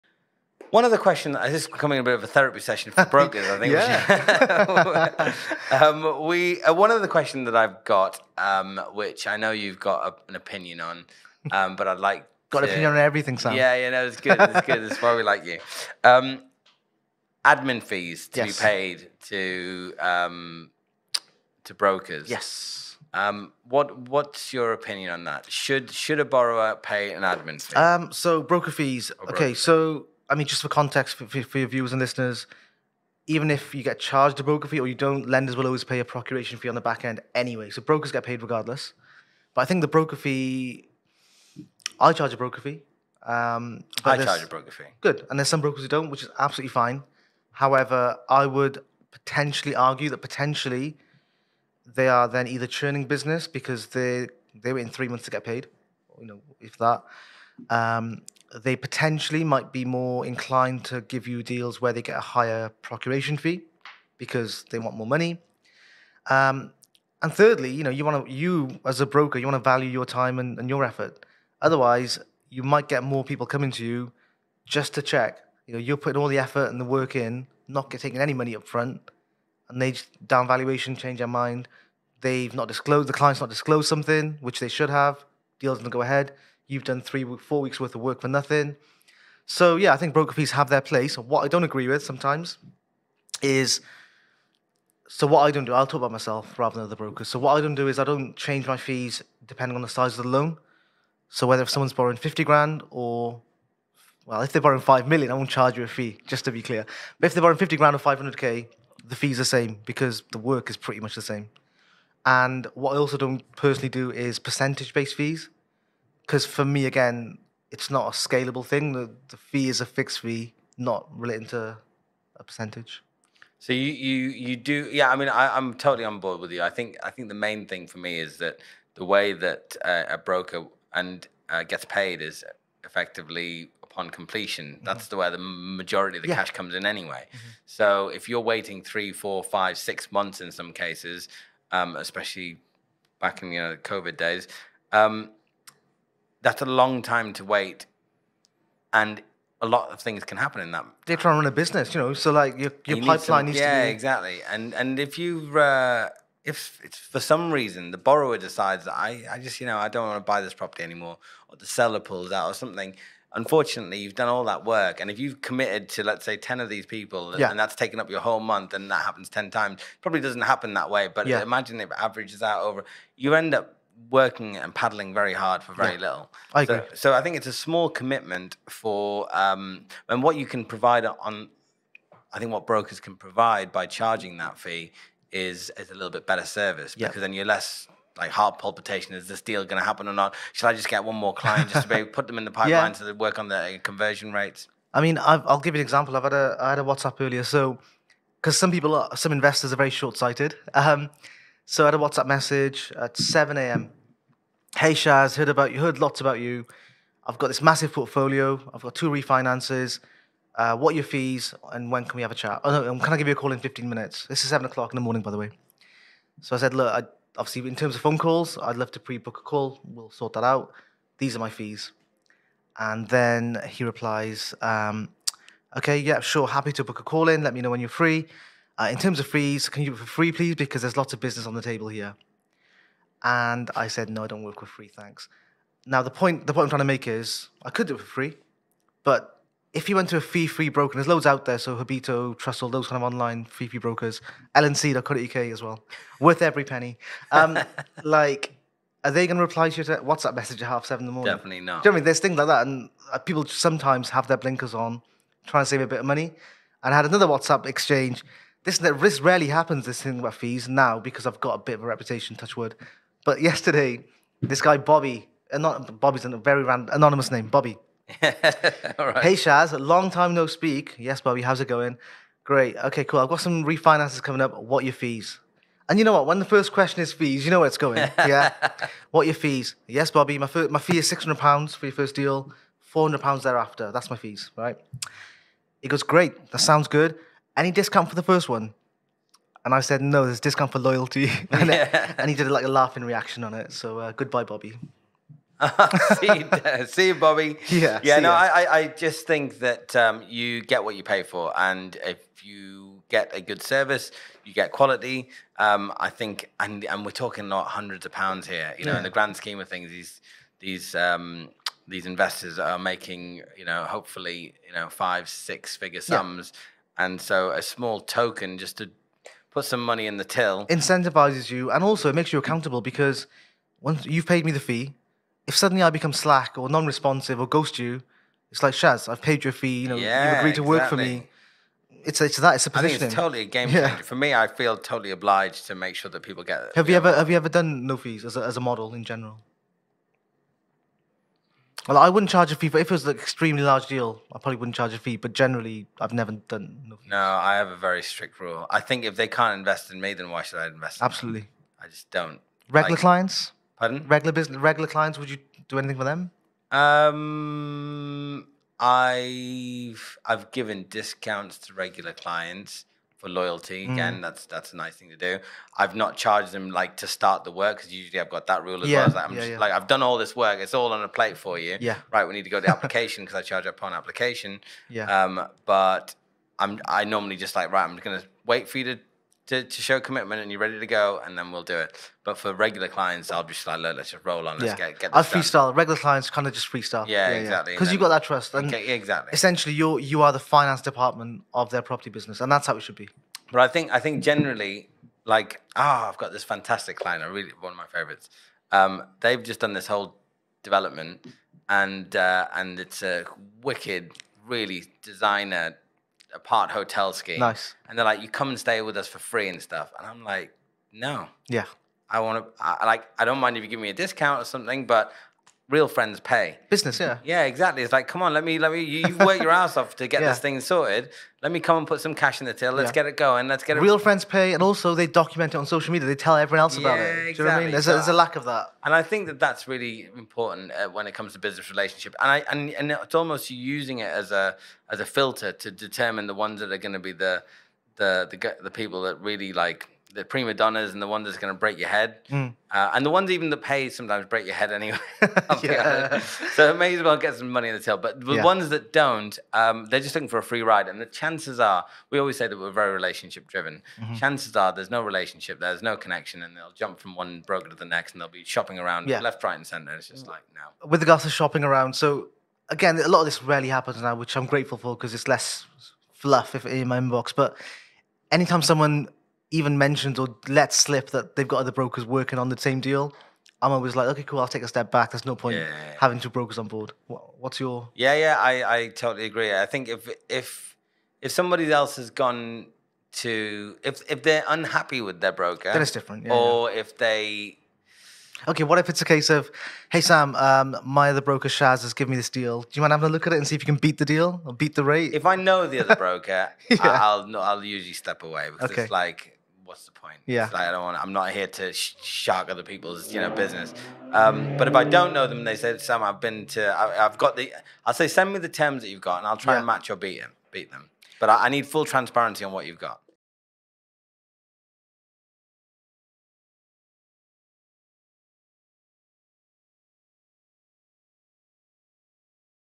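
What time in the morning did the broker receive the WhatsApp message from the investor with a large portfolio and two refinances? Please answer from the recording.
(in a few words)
7 a.m.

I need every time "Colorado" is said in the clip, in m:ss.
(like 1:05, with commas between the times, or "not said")
not said.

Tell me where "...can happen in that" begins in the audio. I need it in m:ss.
2:30.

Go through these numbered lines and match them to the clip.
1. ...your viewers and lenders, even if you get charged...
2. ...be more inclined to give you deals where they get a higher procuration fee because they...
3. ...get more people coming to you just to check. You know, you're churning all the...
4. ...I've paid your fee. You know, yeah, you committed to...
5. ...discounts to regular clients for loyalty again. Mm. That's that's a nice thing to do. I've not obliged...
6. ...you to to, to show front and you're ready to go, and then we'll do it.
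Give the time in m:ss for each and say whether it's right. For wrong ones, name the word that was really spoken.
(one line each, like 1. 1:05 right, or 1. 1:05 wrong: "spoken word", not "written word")
1. 0:31 wrong: "listeners", not "lenders"
2. 0:59 right
3. 1:12 wrong: "putting", not "churning"
4. 5:29 wrong: "agreed", not "committed"
5. 6:00 wrong: "charged", not "obliged"
6. 6:18 wrong: "commitment", not "front".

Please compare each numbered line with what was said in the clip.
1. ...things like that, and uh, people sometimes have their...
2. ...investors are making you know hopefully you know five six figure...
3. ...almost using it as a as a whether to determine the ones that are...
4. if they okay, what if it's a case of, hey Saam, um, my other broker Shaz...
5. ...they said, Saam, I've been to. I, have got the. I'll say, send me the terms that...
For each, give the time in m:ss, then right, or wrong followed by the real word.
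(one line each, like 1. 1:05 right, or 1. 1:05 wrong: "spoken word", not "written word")
1. 4:12 right
2. 5:12 right
3. 7:13 wrong: "filter", not "whether"
4. 8:06 right
5. 8:25 right.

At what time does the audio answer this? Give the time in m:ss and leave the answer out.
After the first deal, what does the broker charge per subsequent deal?
4:42.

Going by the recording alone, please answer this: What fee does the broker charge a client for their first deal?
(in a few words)
£600.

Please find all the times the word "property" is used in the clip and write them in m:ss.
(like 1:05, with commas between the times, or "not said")
2:40, 6:31.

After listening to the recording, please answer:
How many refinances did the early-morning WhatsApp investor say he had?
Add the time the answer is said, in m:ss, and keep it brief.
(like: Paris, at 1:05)
2, at 3:28.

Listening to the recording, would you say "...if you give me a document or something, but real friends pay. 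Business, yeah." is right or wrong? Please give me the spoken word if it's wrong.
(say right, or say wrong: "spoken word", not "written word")
wrong: "discount", not "document".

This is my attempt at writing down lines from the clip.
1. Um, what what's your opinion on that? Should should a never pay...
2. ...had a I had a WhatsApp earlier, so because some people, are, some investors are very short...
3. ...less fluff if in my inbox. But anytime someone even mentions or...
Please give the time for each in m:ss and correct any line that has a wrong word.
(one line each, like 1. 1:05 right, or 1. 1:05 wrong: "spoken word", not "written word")
1. 0:23 wrong: "borrower", not "never"
2. 3:16 right
3. 7:45 right.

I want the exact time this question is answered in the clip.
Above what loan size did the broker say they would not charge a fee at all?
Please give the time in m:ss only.
1:44.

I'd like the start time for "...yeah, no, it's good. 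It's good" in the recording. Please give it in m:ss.
0:13.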